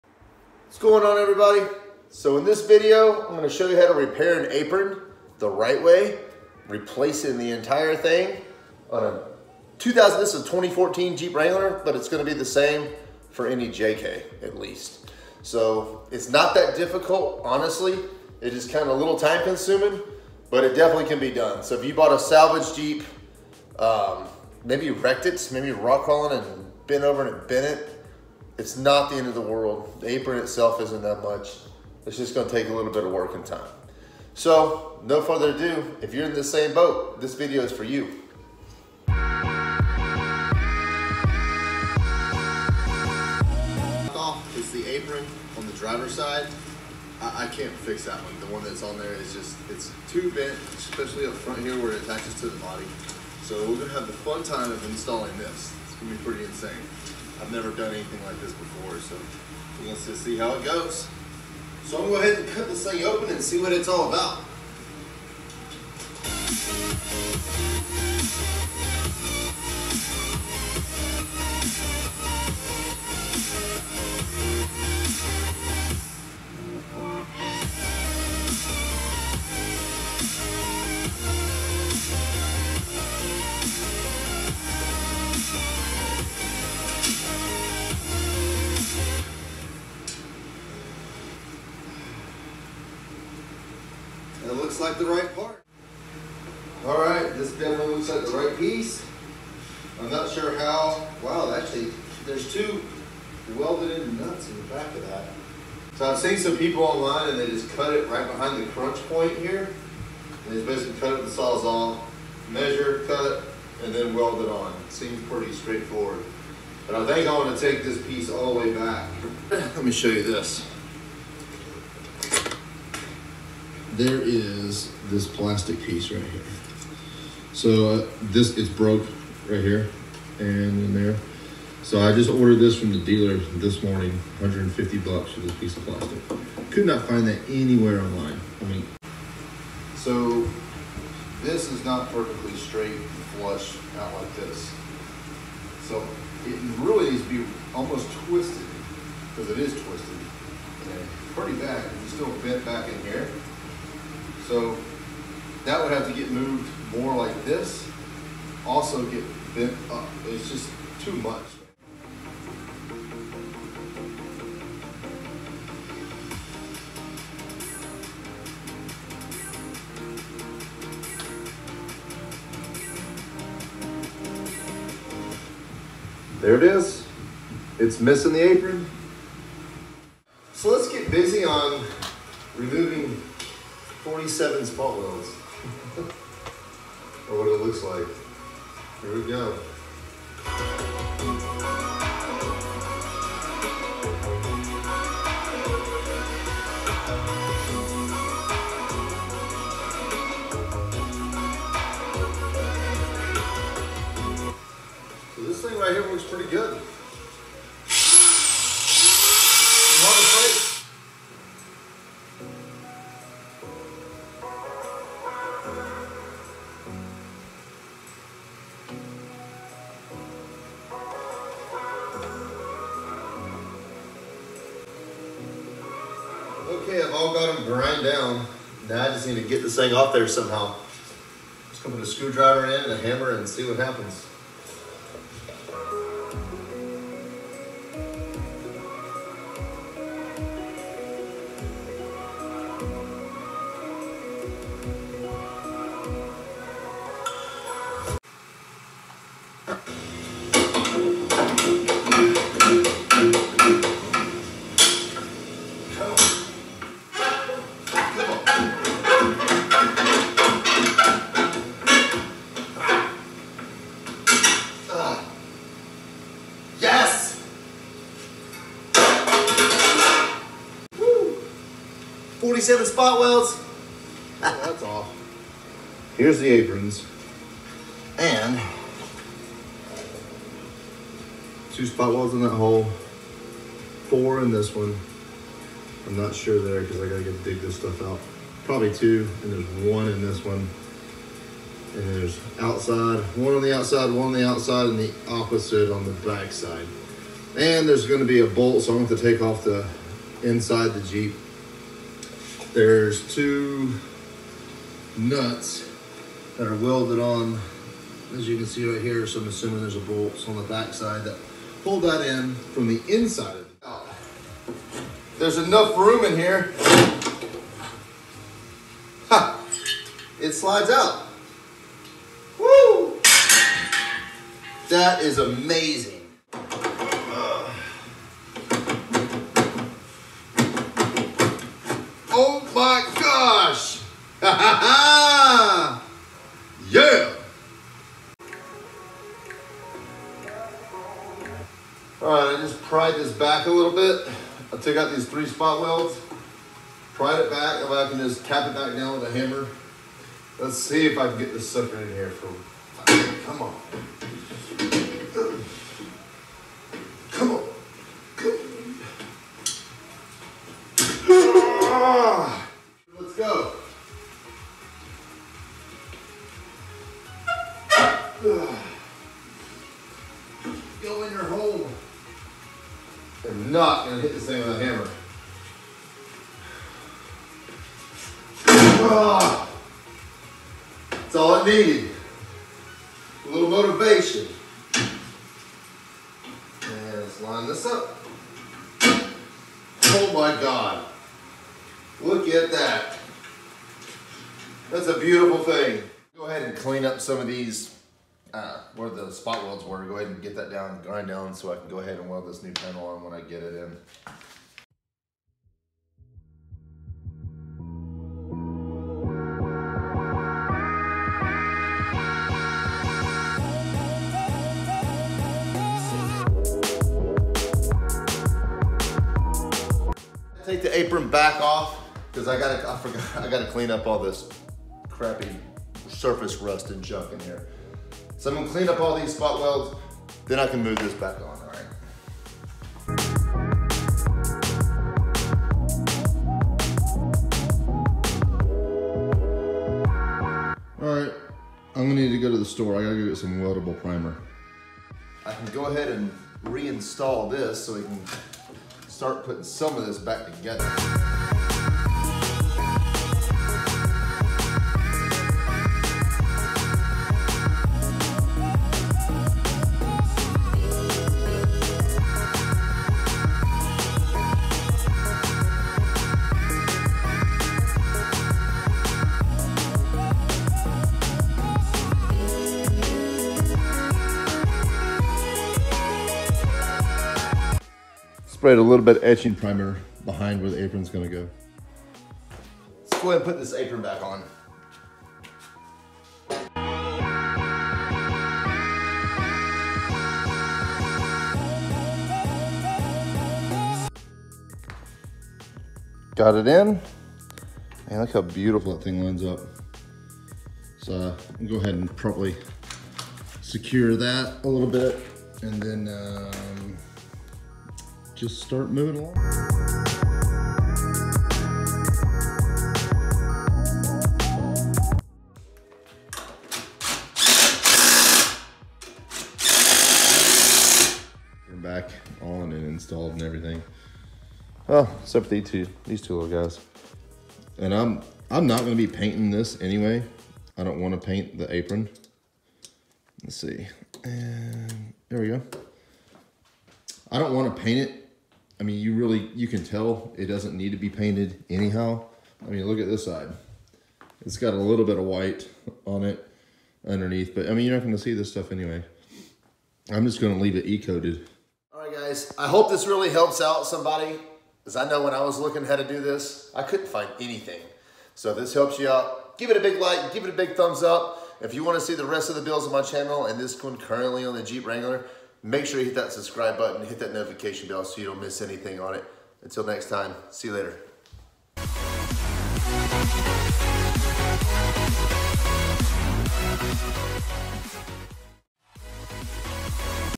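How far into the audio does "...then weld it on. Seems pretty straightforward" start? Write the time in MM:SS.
01:53.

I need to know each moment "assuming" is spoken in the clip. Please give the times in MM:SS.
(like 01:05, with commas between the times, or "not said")
05:09.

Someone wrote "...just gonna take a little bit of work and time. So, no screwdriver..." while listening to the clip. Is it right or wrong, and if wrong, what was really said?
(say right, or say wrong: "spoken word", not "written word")
wrong: "further", not "screwdriver".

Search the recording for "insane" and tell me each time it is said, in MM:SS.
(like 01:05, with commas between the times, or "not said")
00:56.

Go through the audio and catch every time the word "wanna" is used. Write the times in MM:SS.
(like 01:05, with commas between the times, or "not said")
08:50, 08:57, 09:21.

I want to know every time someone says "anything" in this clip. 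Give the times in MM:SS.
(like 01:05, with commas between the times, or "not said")
00:57, 09:17, 09:28.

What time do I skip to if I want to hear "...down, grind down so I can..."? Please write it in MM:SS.
06:40.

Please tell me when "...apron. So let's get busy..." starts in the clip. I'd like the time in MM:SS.
02:58.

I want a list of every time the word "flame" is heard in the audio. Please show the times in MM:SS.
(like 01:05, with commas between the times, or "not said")
not said.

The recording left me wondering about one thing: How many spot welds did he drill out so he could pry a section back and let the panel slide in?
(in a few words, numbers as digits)
3.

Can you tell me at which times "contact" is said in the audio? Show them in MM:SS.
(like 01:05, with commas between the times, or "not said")
not said.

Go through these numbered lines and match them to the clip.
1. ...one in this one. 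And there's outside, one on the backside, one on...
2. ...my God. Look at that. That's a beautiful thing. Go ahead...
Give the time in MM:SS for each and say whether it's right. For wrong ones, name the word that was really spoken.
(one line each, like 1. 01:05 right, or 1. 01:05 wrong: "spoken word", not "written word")
1. 04:49 wrong: "outside", not "backside"
2. 06:30 right.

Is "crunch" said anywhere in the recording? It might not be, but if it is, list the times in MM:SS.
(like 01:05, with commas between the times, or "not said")
01:48.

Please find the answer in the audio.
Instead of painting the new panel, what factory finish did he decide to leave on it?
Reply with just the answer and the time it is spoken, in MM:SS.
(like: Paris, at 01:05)
E-coated, at 09:10.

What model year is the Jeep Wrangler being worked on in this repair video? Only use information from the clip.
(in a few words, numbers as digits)
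2014.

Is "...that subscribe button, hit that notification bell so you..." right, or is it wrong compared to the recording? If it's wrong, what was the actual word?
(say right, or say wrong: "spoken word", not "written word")
right.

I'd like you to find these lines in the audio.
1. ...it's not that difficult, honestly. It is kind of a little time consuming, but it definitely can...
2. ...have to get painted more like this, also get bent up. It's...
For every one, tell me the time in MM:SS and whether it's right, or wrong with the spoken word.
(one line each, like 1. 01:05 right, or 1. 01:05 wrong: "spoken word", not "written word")
1. 00:16 right
2. 02:35 wrong: "moved", not "painted".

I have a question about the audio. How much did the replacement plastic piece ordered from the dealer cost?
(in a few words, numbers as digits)
$150.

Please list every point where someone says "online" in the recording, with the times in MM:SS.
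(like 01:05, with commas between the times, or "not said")
01:46, 02:17.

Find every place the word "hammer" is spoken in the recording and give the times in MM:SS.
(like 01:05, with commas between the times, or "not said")
03:52, 05:49, 06:14.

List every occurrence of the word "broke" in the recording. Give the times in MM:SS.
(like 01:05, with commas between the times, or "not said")
02:08.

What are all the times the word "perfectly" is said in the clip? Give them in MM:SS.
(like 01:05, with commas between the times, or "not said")
02:22.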